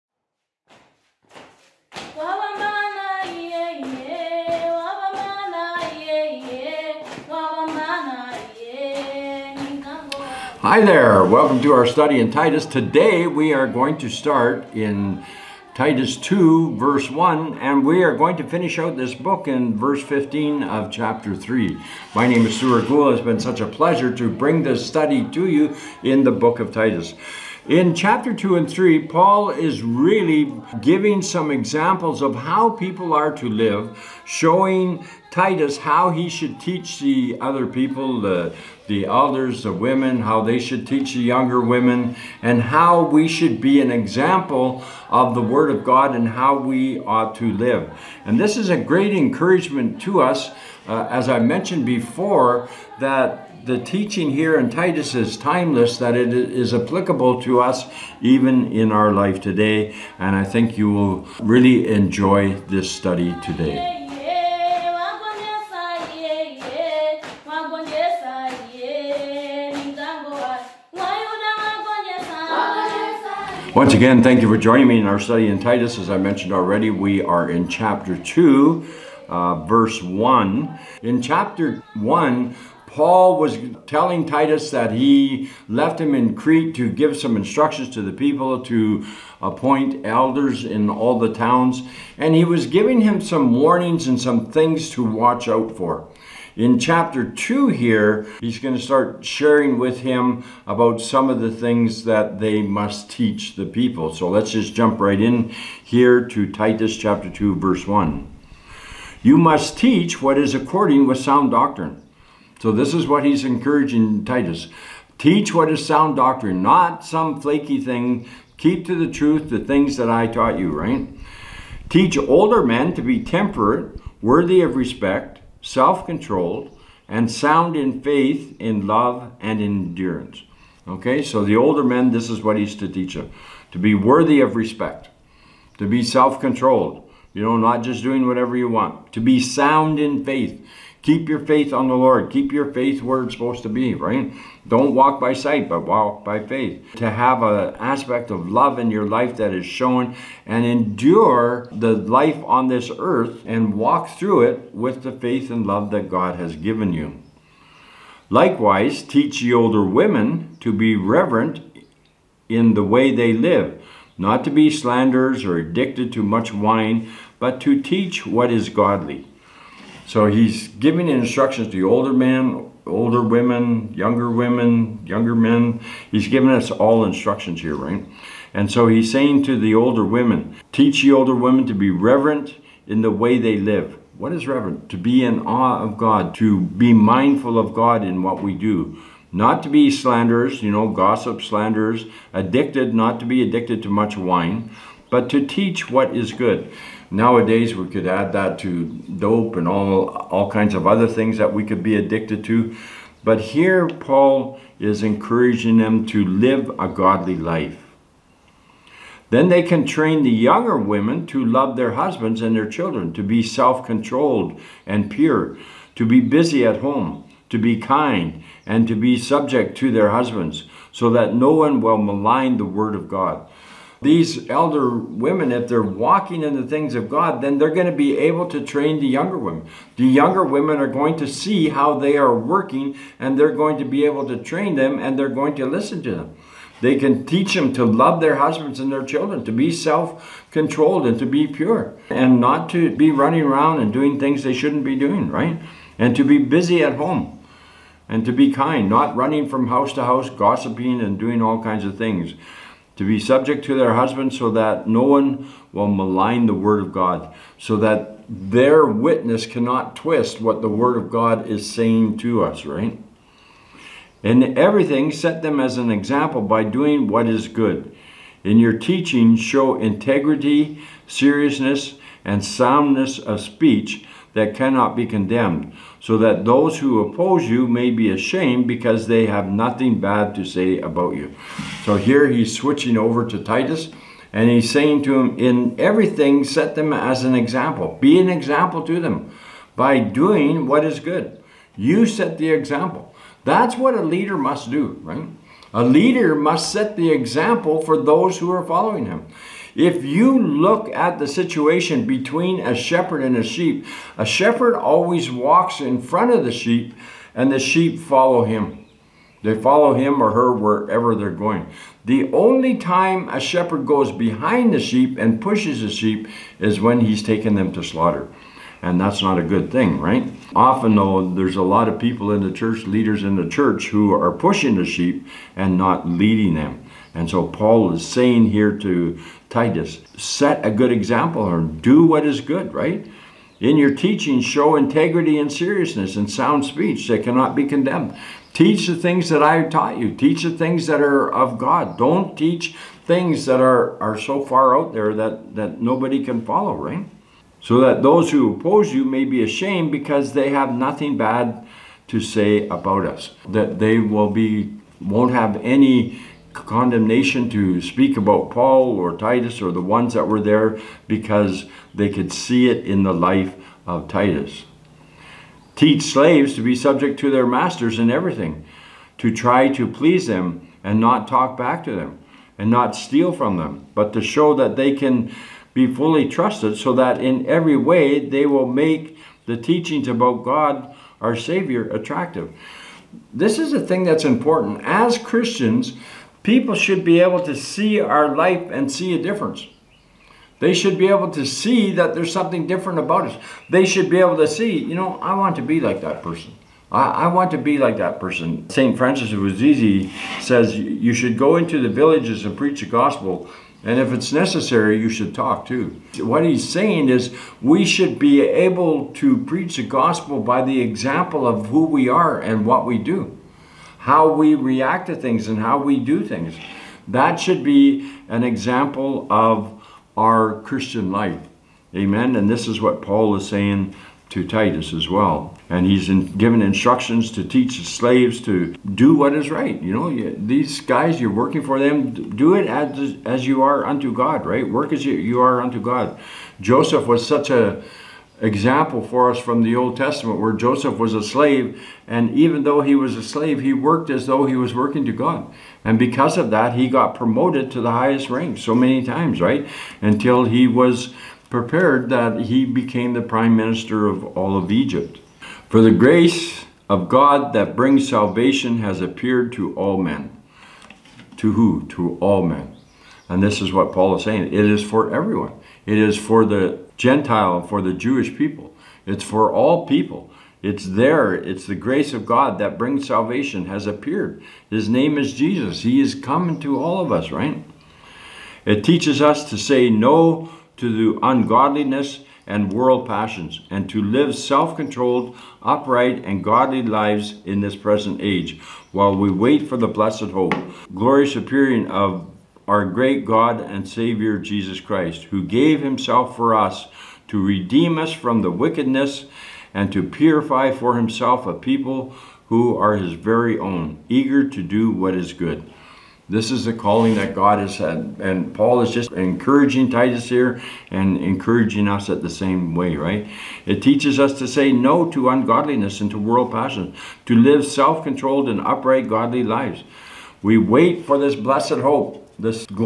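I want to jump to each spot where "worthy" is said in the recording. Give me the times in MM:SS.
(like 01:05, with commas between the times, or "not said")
02:04, 02:13.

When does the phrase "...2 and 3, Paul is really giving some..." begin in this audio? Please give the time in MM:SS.
00:28.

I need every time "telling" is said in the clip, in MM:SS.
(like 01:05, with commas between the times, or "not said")
01:23.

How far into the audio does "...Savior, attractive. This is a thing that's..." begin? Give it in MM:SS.
06:21.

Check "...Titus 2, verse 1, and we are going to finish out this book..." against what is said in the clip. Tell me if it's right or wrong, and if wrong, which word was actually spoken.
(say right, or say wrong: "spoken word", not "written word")
right.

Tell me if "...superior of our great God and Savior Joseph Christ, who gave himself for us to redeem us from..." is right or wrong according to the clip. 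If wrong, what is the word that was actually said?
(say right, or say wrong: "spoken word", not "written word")
wrong: "Jesus", not "Joseph".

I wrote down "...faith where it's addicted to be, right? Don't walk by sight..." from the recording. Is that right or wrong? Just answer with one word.
wrong.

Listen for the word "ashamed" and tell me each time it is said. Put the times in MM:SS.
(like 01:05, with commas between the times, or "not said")
04:38, 05:49.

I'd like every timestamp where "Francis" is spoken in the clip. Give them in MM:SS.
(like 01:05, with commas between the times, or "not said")
06:38.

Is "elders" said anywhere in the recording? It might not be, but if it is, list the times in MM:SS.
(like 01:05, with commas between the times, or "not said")
00:39, 01:30, 03:44.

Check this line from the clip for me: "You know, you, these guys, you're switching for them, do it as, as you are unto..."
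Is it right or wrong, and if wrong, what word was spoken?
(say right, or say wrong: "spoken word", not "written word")
wrong: "working", not "switching".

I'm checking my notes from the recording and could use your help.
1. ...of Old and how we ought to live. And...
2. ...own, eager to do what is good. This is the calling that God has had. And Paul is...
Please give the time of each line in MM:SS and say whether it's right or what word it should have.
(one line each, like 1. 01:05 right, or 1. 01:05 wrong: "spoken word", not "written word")
1. 00:45 wrong: "God", not "Old"
2. 08:23 right.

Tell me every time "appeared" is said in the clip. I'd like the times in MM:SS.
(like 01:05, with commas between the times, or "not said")
07:38, 07:53.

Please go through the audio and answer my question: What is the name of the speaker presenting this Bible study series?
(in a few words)
Stuart Gould.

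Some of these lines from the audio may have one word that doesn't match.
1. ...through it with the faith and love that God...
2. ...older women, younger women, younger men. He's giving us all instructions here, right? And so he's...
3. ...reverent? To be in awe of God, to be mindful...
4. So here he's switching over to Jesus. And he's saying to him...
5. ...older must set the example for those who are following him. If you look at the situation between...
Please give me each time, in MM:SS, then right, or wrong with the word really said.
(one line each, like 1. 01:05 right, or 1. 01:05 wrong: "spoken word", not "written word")
1. 02:34 right
2. 02:52 right
3. 03:04 right
4. 04:41 wrong: "Titus", not "Jesus"
5. 04:55 wrong: "leader", not "older".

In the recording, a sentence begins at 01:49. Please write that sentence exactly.
You must teach what is according with sound doctrine so this is what he's encouraging Titus.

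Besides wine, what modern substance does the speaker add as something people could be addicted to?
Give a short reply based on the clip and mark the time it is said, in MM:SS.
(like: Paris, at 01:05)
Dope, at 03:19.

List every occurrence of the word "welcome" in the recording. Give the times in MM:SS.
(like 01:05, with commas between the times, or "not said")
00:11.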